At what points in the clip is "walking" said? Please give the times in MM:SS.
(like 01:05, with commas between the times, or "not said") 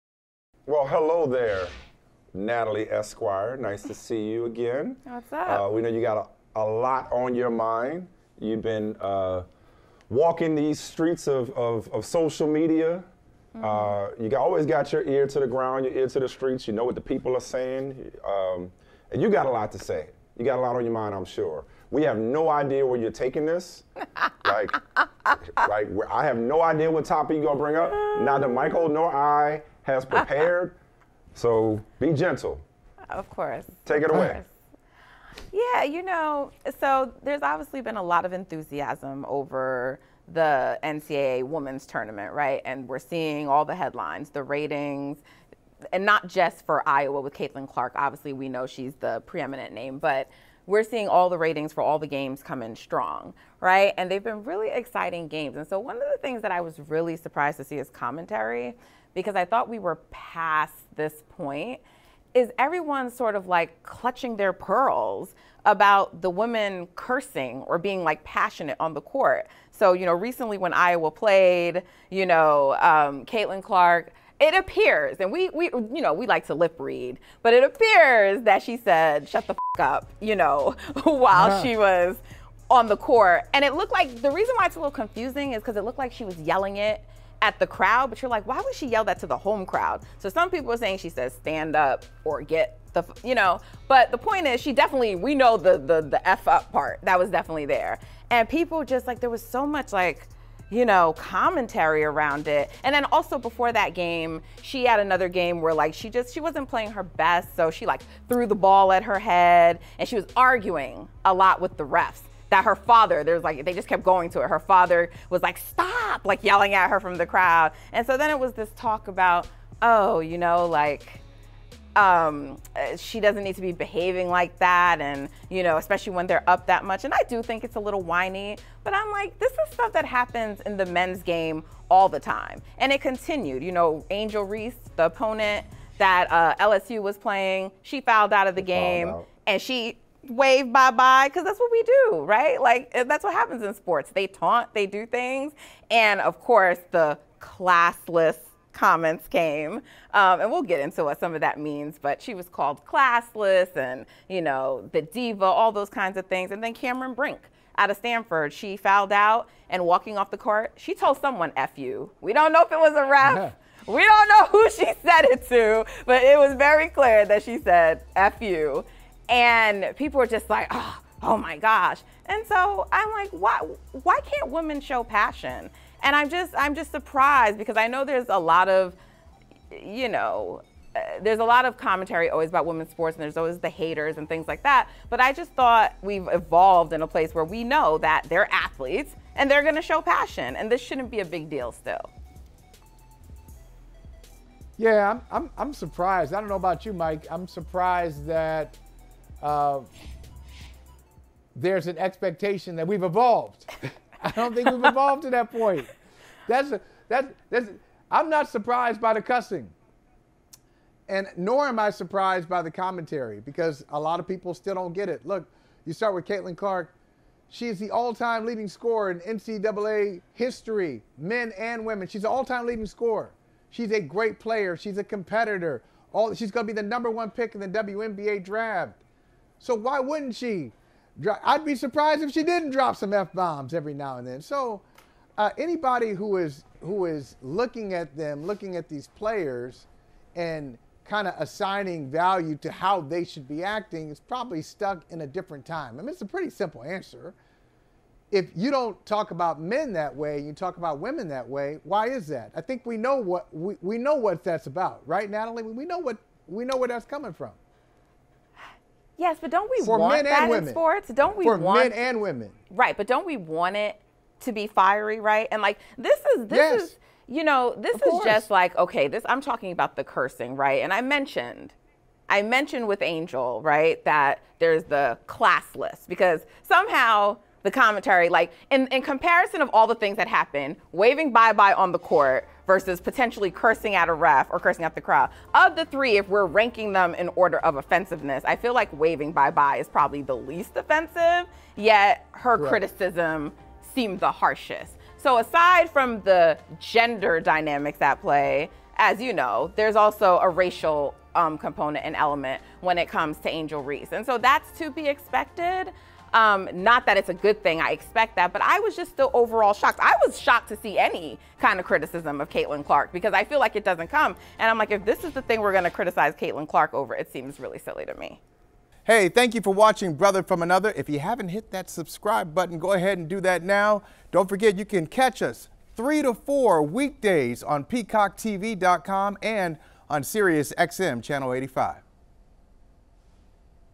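00:10, 02:39.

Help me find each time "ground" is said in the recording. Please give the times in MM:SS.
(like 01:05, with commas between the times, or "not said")
00:15.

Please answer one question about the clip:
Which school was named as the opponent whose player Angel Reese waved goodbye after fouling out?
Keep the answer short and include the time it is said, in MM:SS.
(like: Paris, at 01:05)
LSU, at 02:16.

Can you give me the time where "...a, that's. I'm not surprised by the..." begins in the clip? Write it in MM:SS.
03:26.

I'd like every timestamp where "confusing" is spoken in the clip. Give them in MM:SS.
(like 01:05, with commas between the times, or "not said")
01:24.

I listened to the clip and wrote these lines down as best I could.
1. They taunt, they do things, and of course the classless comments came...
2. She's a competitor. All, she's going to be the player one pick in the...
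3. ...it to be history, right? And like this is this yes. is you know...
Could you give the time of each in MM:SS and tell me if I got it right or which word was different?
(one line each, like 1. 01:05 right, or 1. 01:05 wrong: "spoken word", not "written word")
1. 02:24 right
2. 03:44 wrong: "number", not "player"
3. 04:23 wrong: "fiery", not "history".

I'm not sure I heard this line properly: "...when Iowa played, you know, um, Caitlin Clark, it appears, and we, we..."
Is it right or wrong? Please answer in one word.
right.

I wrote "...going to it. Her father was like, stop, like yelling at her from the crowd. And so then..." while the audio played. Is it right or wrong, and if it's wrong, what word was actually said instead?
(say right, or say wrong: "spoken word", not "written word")
right.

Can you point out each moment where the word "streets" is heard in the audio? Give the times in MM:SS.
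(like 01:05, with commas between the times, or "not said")
00:10, 00:16.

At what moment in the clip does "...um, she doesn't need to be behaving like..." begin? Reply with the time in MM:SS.
02:01.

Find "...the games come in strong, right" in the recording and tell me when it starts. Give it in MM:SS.
00:51.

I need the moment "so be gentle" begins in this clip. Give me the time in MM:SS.
00:31.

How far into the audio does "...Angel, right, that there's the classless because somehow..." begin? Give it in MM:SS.
04:33.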